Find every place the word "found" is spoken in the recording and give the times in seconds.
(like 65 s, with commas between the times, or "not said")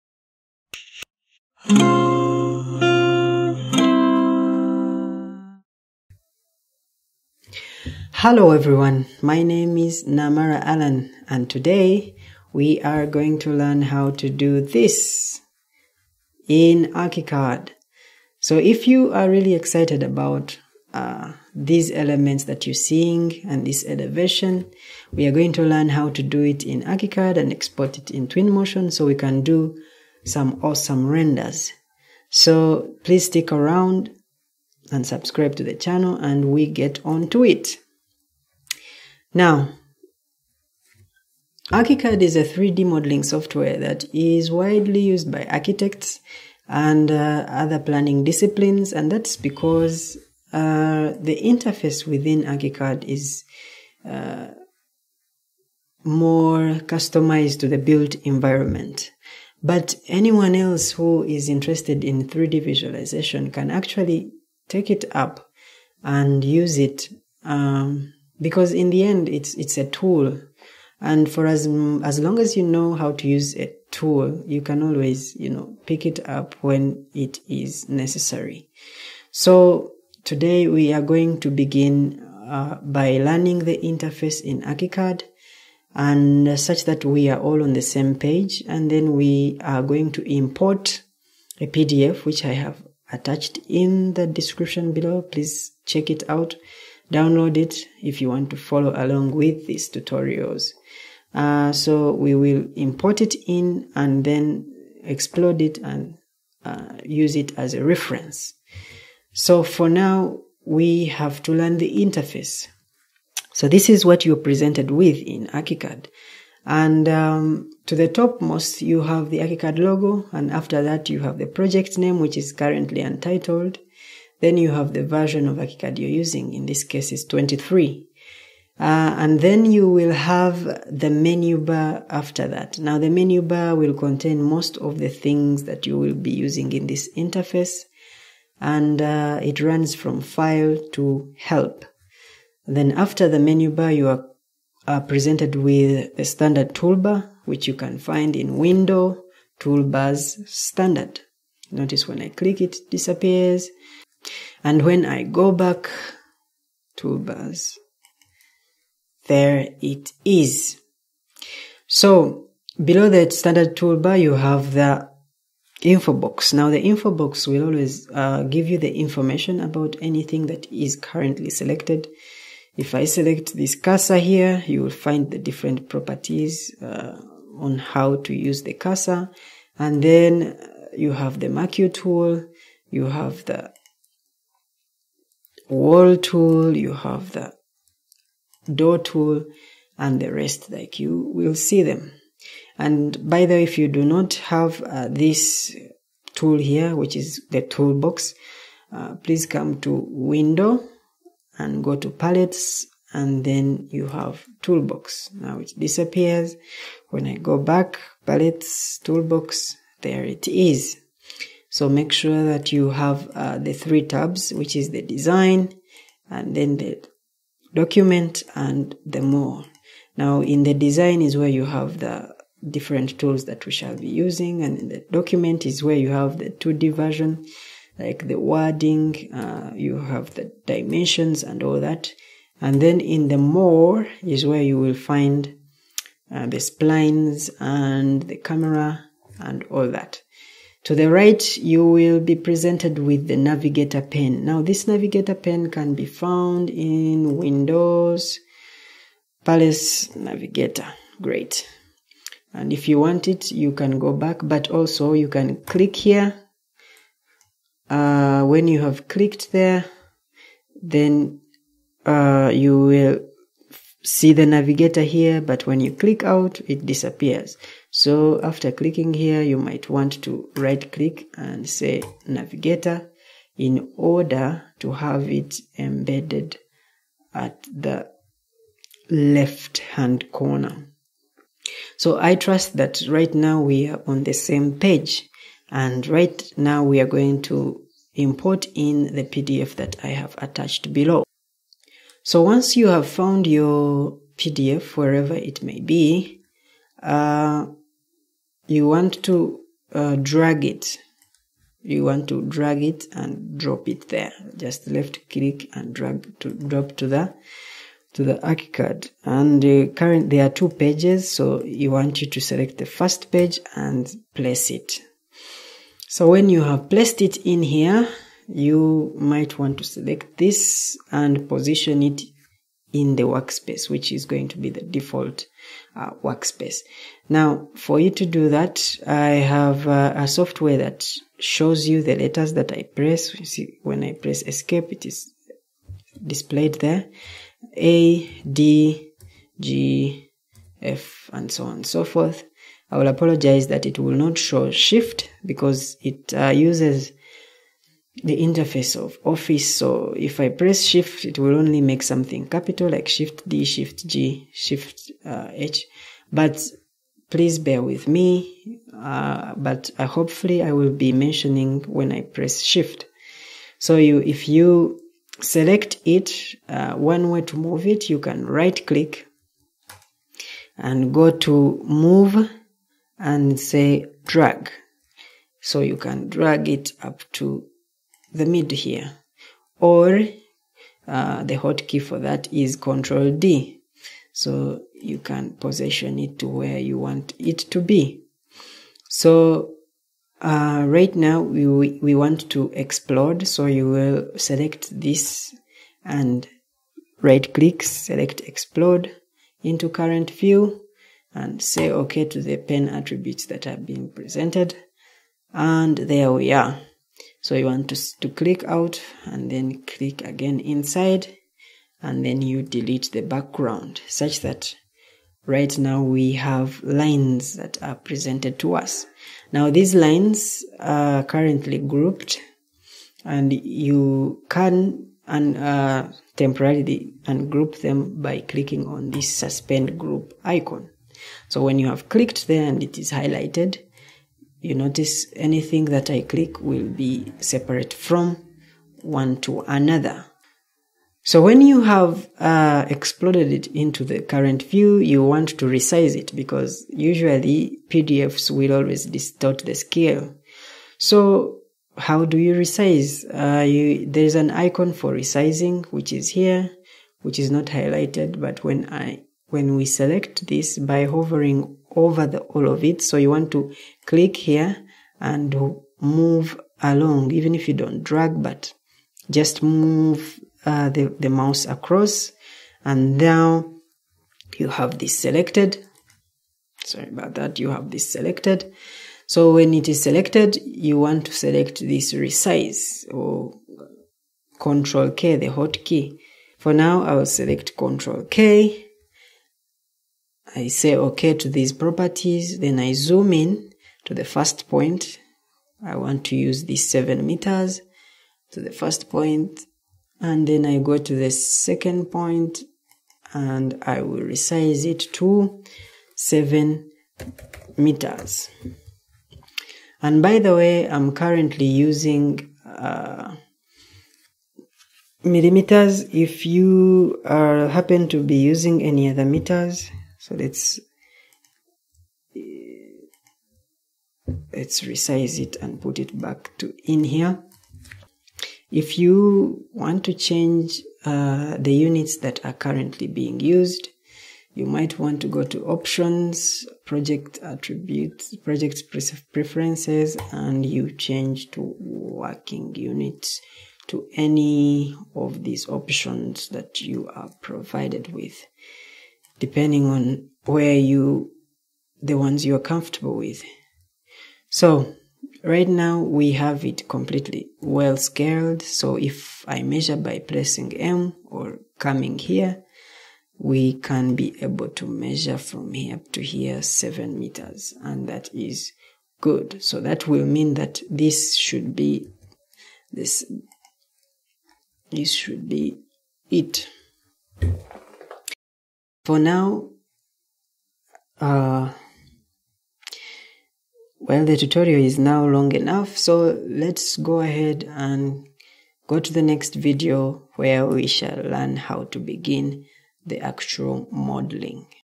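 246 s, 293 s.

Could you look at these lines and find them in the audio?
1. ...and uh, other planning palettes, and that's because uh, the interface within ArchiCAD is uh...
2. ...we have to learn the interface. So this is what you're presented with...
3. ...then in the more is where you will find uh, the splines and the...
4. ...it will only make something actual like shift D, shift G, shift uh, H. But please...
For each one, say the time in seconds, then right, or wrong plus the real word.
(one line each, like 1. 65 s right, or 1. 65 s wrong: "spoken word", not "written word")
1. 46 s wrong: "disciplines", not "palettes"
2. 110 s right
3. 232 s right
4. 351 s wrong: "capital", not "actual".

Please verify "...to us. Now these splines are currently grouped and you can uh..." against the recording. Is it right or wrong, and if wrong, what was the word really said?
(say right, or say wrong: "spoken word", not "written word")
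wrong: "lines", not "splines".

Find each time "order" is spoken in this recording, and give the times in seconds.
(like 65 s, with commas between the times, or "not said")
273 s.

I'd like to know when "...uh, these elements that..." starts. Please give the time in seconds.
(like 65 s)
20 s.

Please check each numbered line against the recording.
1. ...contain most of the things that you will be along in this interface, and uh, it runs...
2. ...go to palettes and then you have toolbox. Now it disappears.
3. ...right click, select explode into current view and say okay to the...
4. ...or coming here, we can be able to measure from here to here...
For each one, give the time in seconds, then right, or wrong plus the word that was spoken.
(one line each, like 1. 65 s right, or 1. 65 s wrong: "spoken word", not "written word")
1. 133 s wrong: "using", not "along"
2. 201 s right
3. 397 s right
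4. 561 s right.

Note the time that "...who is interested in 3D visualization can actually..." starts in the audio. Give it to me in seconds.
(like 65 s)
60 s.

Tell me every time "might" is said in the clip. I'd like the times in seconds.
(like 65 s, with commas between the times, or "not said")
269 s, 319 s, 534 s.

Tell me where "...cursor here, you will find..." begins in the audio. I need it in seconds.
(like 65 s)
173 s.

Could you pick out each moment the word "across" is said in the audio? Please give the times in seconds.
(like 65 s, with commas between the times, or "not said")
471 s.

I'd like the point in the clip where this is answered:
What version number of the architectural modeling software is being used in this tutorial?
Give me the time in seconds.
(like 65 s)
127 s.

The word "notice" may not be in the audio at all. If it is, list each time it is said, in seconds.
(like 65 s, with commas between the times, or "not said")
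151 s, 434 s.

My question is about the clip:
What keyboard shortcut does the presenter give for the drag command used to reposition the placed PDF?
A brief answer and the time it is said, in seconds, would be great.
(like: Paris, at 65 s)
Control D, at 382 s.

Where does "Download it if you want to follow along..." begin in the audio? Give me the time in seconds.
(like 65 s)
97 s.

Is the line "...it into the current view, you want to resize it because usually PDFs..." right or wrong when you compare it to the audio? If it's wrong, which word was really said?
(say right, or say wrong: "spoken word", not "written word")
right.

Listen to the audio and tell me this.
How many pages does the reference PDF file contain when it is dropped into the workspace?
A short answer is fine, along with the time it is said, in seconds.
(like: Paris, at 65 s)
2, at 310 s.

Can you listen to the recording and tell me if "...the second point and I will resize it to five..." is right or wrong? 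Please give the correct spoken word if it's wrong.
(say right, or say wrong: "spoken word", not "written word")
wrong: "seven", not "five".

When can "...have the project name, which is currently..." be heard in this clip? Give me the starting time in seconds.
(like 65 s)
121 s.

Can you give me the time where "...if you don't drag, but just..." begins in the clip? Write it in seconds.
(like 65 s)
467 s.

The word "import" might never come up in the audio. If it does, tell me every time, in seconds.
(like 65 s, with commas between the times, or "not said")
90 s, 102 s, 288 s.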